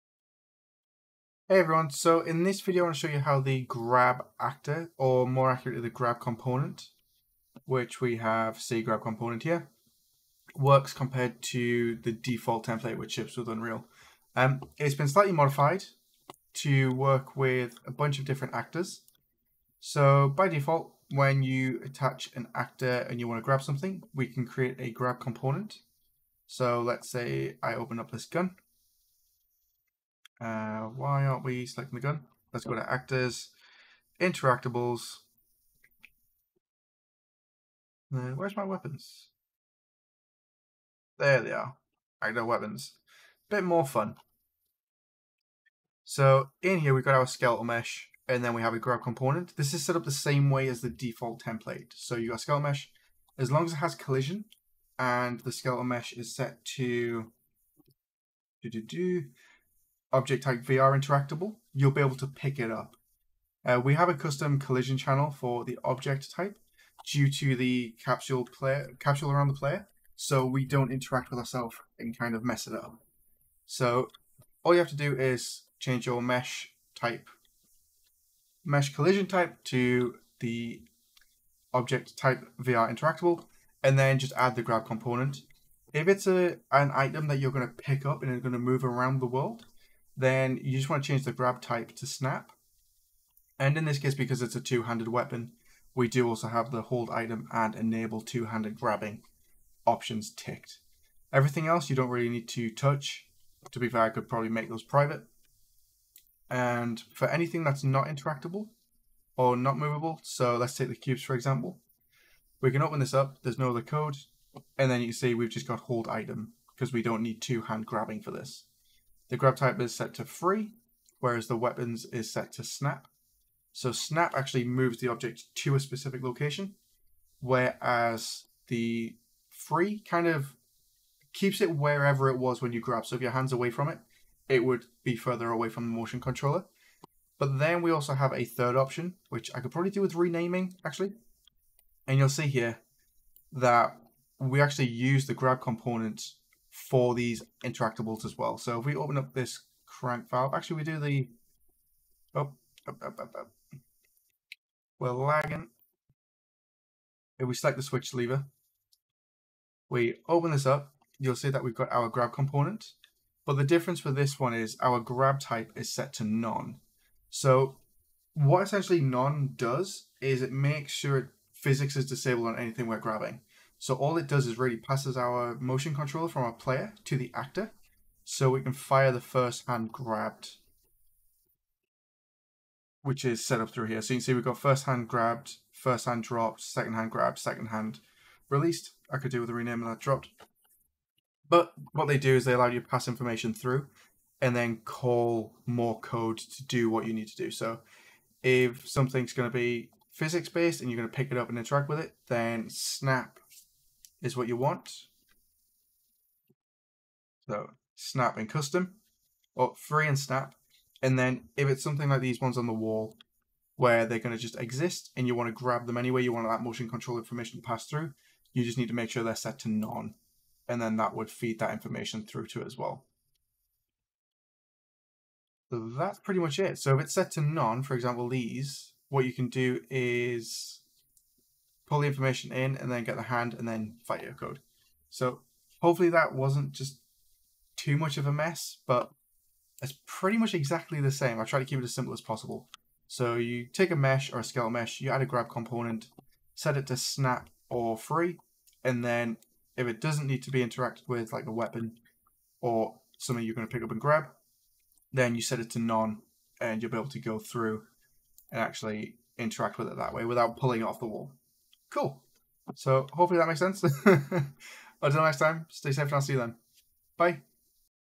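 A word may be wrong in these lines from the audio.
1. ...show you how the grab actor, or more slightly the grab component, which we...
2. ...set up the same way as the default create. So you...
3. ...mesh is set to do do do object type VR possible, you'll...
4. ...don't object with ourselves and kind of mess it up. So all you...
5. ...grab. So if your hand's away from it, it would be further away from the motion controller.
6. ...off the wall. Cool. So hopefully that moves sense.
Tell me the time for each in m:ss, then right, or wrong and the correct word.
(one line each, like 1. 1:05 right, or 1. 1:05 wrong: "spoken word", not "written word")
1. 0:03 wrong: "accurately", not "slightly"
2. 0:49 wrong: "template", not "create"
3. 0:55 wrong: "interactable", not "possible"
4. 1:10 wrong: "interact", not "object"
5. 2:12 right
6. 4:20 wrong: "makes", not "moves".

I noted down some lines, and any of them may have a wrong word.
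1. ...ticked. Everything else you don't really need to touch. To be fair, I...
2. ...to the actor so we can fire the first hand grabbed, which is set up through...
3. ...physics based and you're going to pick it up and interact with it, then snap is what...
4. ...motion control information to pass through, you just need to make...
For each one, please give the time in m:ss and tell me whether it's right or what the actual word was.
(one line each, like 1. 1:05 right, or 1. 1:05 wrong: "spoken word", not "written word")
1. 1:40 right
2. 2:57 right
3. 3:20 right
4. 3:36 right.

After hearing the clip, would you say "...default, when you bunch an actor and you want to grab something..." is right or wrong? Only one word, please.
wrong.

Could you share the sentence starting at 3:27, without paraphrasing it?
So snap and custom, or oh, free and snap.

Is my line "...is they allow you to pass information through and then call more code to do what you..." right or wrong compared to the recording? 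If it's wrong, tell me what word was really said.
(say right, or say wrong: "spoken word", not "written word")
right.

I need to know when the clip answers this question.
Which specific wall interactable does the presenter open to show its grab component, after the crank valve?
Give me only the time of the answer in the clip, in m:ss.
2:37.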